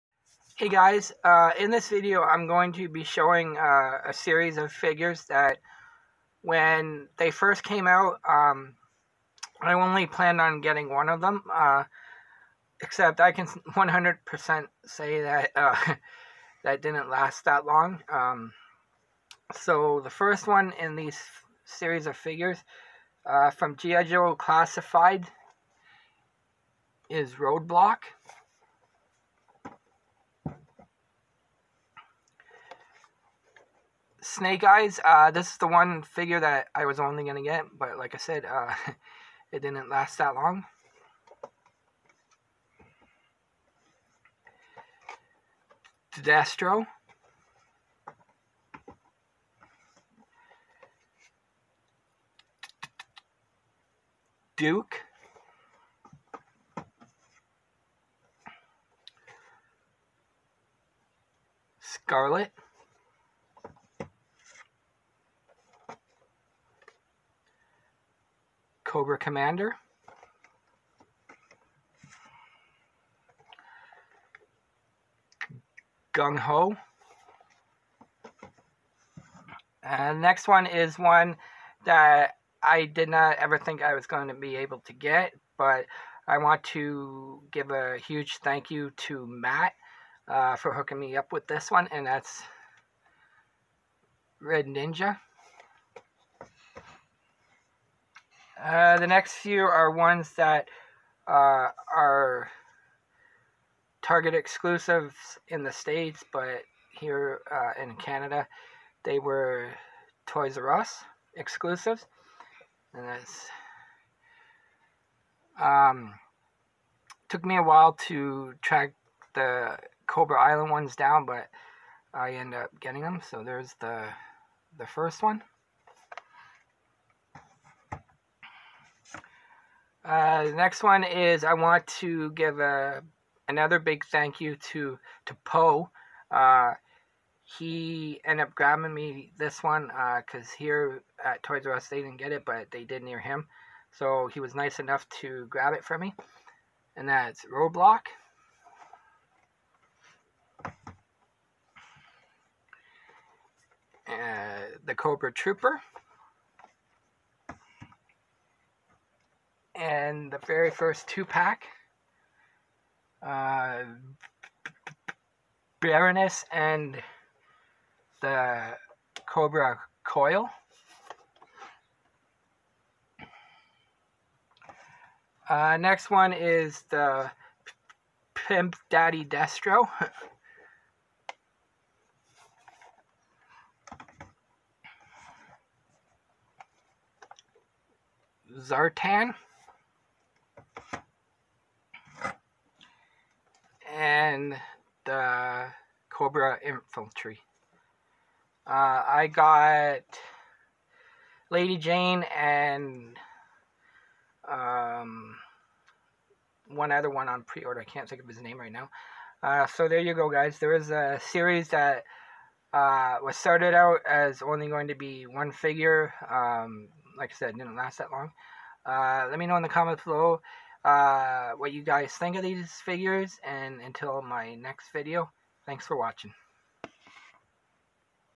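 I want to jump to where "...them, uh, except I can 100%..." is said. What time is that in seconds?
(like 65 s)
11 s.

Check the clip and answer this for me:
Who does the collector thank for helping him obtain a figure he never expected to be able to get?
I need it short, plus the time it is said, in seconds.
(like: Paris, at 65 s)
Matt, at 89 s.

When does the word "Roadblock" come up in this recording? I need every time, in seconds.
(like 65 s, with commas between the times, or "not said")
27 s, 147 s.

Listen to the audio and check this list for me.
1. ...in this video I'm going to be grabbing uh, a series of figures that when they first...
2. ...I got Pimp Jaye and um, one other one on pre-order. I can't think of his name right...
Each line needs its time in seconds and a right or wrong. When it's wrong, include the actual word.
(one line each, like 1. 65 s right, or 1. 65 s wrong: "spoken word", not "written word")
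1. 1 s wrong: "showing", not "grabbing"
2. 199 s wrong: "Lady", not "Pimp".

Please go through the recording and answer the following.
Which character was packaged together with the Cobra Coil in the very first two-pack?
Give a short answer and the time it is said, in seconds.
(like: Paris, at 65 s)
Baroness, at 165 s.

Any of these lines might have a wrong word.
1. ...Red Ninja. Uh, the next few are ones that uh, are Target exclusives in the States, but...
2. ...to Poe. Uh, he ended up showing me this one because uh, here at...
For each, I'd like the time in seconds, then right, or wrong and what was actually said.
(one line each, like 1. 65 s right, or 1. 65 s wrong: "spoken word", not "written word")
1. 94 s right
2. 135 s wrong: "grabbing", not "showing".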